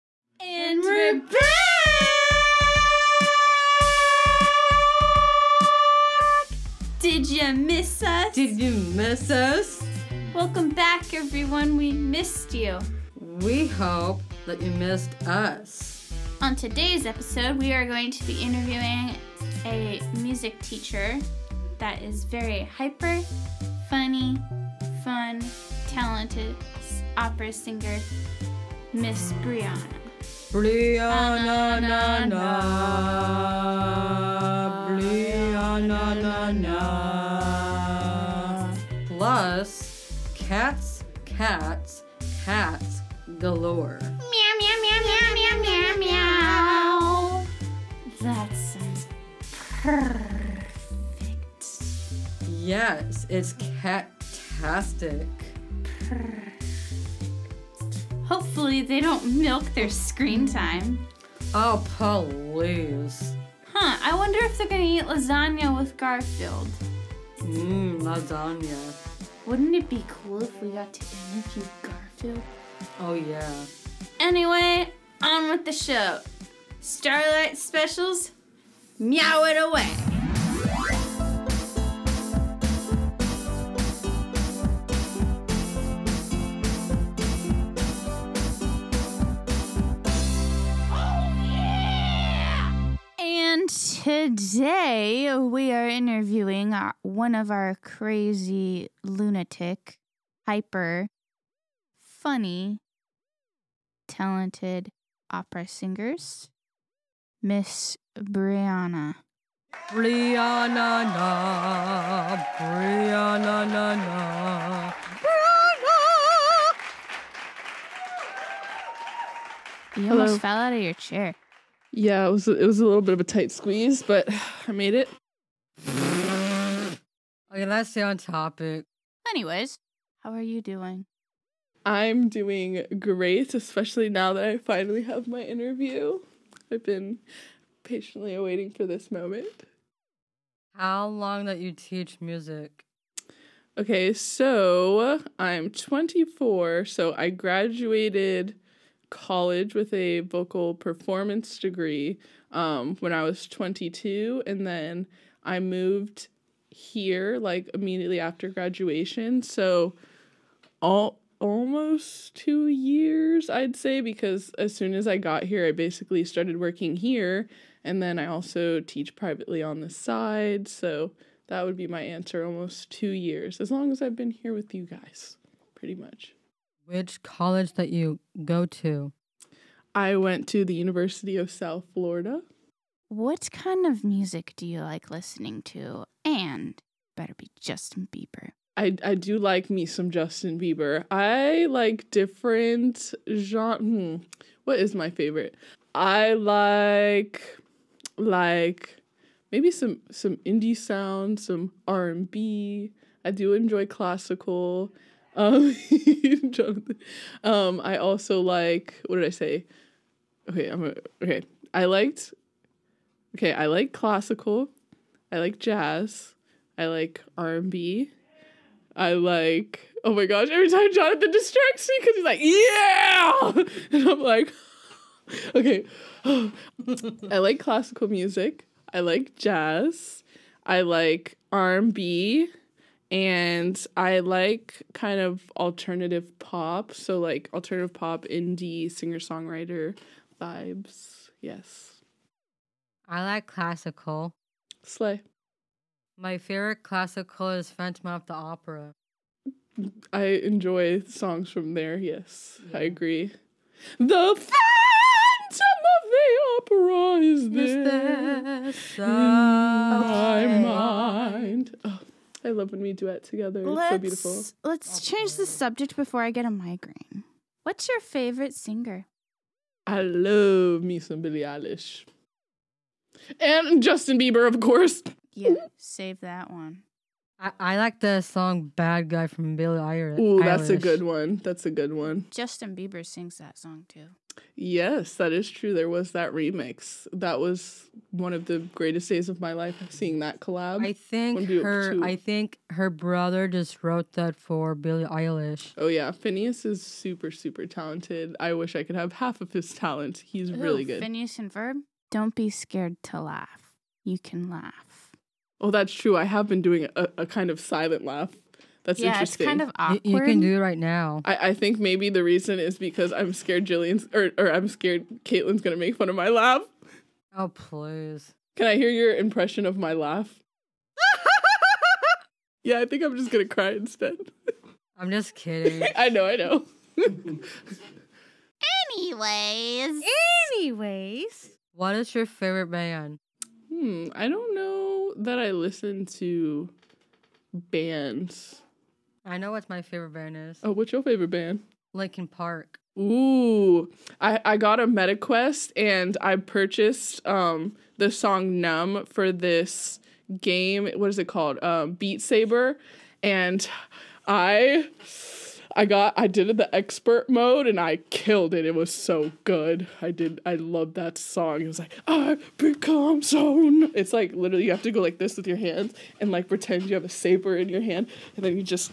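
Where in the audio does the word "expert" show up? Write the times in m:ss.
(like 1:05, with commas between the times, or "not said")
5:56.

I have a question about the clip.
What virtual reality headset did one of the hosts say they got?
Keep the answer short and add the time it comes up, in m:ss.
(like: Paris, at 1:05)
MetaQuest, at 5:44.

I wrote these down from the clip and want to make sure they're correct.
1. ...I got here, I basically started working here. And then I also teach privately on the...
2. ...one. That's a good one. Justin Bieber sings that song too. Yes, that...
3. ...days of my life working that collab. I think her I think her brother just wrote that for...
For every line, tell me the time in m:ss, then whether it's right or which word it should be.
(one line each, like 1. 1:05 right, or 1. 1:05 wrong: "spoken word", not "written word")
1. 2:45 right
2. 4:41 right
3. 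4:49 wrong: "seeing", not "working".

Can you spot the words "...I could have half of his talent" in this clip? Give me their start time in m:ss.
4:58.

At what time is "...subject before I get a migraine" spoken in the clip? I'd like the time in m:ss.
4:25.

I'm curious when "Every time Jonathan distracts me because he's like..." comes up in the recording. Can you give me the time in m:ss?
3:40.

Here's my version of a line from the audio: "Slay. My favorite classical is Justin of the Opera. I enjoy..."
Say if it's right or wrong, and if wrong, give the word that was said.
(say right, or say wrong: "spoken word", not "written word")
wrong: "Phantom", not "Justin".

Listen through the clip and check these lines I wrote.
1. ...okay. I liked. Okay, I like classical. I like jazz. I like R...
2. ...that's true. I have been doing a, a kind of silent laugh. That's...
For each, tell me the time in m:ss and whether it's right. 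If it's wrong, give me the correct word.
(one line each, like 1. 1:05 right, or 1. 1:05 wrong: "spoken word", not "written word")
1. 3:31 right
2. 5:05 right.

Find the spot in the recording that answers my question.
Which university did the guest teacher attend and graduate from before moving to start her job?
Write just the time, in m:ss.
3:00.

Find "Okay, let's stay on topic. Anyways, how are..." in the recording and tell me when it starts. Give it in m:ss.
2:07.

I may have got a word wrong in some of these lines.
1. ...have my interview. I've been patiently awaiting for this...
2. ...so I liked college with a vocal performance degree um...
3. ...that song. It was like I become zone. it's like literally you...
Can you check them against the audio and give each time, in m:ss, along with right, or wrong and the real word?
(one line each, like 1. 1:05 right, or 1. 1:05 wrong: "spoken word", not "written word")
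1. 2:15 right
2. 2:26 wrong: "graduated", not "liked"
3. 6:00 right.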